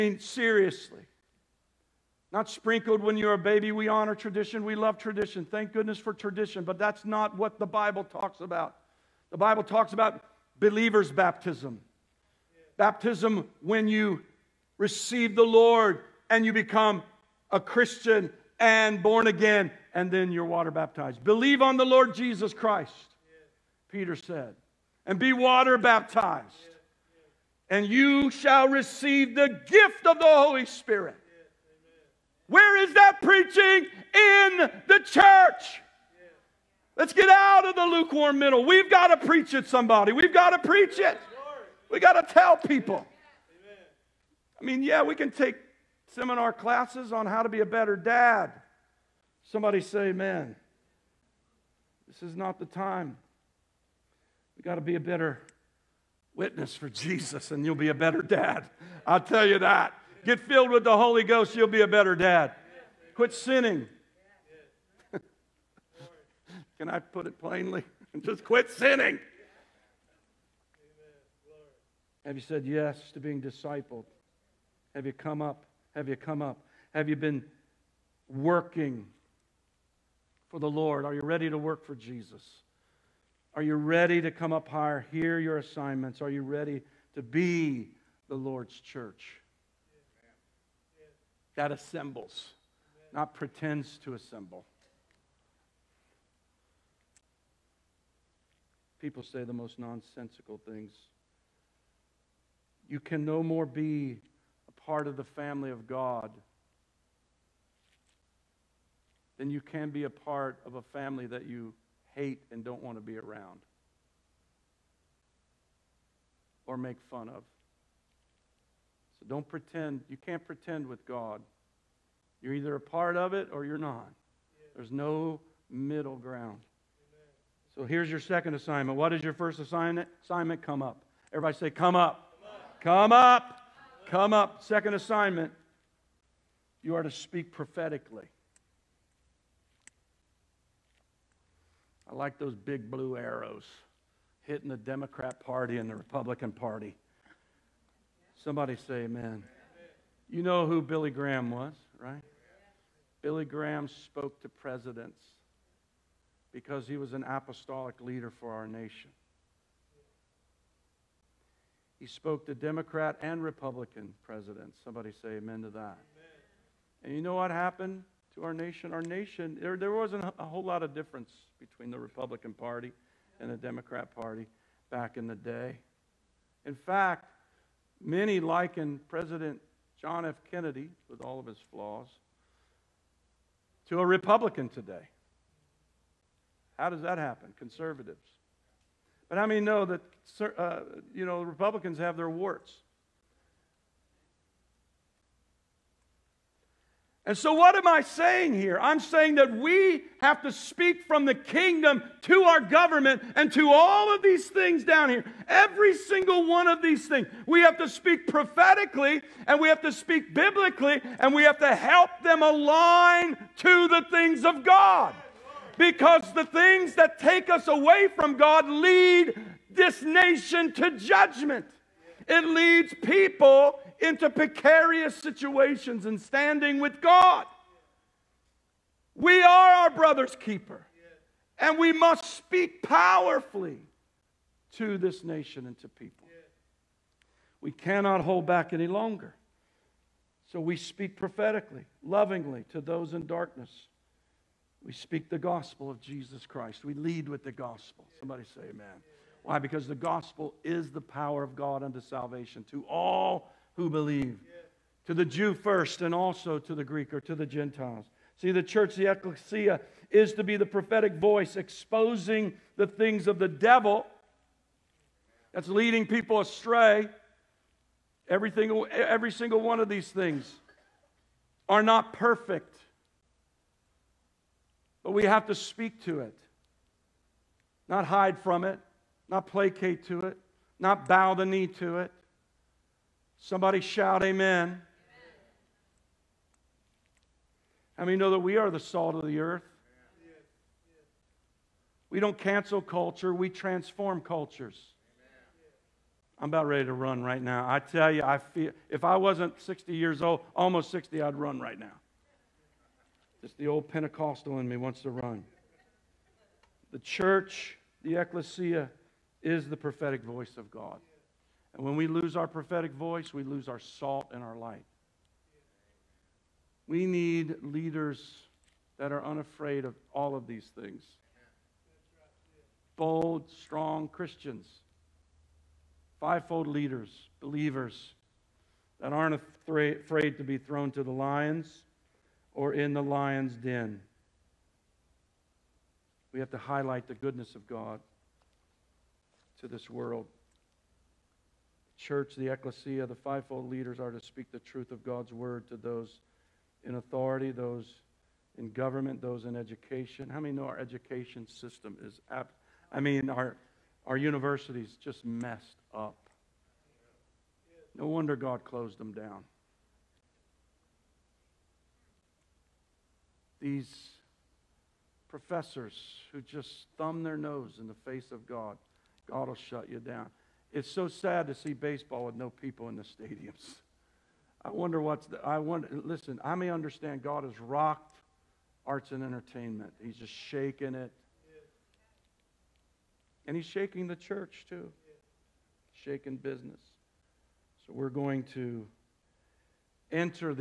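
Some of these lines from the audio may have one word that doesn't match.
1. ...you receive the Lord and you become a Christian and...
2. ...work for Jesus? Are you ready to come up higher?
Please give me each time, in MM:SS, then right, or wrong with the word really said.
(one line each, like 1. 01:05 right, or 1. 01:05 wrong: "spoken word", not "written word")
1. 00:13 right
2. 01:21 right.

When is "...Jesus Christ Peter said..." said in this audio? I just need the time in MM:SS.
00:22.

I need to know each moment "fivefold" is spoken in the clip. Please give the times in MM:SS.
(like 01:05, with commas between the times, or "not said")
05:26, 05:43.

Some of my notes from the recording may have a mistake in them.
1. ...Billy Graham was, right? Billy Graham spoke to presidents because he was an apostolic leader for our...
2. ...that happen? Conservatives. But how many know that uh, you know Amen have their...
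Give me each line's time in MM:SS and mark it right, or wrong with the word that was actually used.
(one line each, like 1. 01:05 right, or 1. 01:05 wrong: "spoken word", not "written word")
1. 02:30 right
2. 03:07 wrong: "Republicans", not "Amen".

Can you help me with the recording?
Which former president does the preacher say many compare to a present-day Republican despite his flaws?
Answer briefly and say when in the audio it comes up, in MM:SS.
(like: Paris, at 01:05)
John F. Kennedy, at 02:59.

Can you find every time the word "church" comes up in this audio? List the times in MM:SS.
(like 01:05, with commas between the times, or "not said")
00:35, 01:28, 04:18, 05:06, 05:41, 06:24.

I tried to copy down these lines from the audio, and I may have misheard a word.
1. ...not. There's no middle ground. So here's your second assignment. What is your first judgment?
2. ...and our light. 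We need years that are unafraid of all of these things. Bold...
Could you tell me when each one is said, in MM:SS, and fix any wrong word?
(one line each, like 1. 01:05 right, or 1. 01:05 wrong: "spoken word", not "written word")
1. 02:03 wrong: "assignment", not "judgment"
2. 05:14 wrong: "leaders", not "years".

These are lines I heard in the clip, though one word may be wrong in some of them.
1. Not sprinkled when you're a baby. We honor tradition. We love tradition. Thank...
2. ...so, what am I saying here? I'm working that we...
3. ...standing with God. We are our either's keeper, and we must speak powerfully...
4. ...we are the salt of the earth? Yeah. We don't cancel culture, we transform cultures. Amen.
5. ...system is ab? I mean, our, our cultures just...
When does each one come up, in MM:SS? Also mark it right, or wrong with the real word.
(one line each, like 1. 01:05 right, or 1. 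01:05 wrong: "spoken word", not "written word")
1. 00:02 right
2. 03:17 wrong: "saying", not "working"
3. 03:46 wrong: "brother", not "either"
4. 04:48 right
5. 05:51 wrong: "universities", not "cultures".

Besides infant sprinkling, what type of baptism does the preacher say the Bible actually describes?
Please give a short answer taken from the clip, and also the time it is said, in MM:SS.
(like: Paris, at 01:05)
believer's baptism, at 00:10.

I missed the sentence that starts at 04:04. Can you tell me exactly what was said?
We speak the gospel of Jesus Christ.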